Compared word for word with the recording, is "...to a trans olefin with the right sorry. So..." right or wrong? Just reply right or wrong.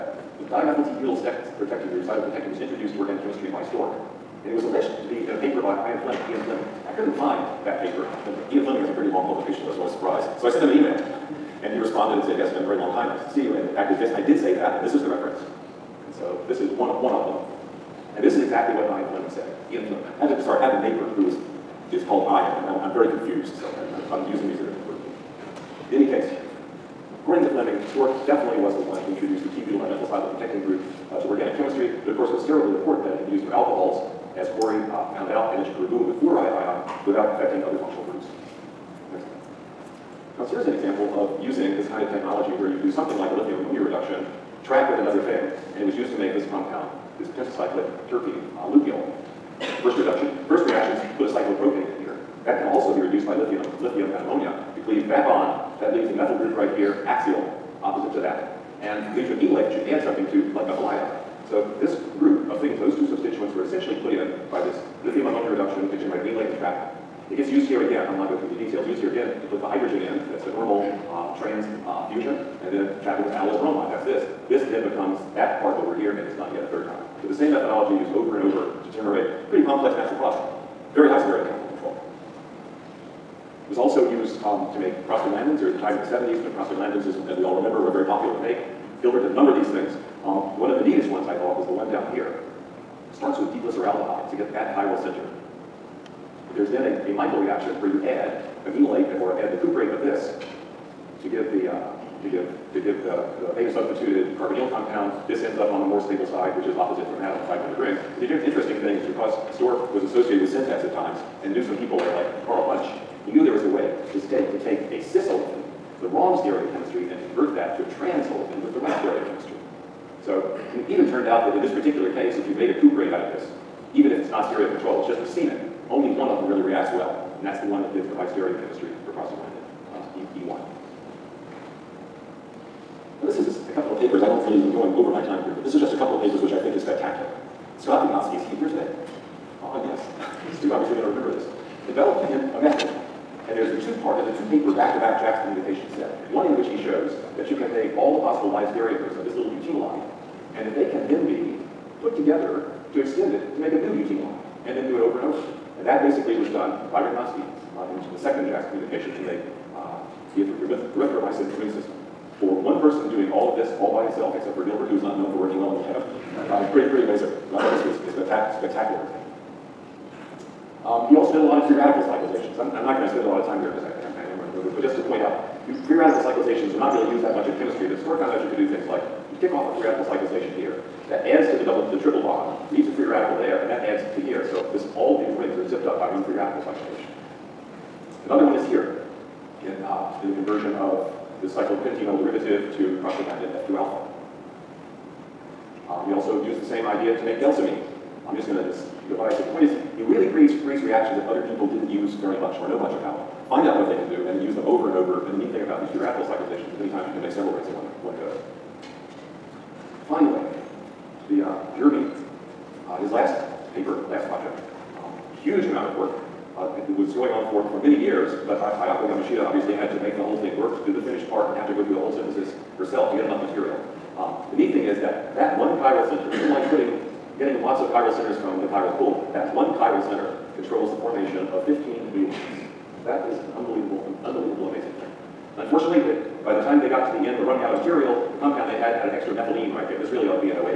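wrong.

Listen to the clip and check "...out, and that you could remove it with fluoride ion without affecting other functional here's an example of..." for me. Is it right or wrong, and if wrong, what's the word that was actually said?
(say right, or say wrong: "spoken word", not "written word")
right.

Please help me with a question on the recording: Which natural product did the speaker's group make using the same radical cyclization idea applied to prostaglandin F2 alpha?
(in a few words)
delsamine.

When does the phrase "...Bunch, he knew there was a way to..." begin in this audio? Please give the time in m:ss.
1:52.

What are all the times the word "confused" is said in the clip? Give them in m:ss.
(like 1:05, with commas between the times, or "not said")
0:23.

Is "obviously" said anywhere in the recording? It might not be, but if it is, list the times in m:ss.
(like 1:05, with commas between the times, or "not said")
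2:20, 3:39.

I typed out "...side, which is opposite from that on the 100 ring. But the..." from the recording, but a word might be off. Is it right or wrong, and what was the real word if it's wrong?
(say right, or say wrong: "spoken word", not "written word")
wrong: "500", not "100".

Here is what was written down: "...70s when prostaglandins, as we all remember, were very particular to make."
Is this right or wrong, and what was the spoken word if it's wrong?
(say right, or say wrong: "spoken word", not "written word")
wrong: "popular", not "particular".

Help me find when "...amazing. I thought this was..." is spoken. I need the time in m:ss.
2:47.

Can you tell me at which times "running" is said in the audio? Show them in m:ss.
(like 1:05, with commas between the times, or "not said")
2:54, 3:57.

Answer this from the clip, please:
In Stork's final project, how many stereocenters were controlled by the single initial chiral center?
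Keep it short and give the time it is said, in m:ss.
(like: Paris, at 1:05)
15, at 3:51.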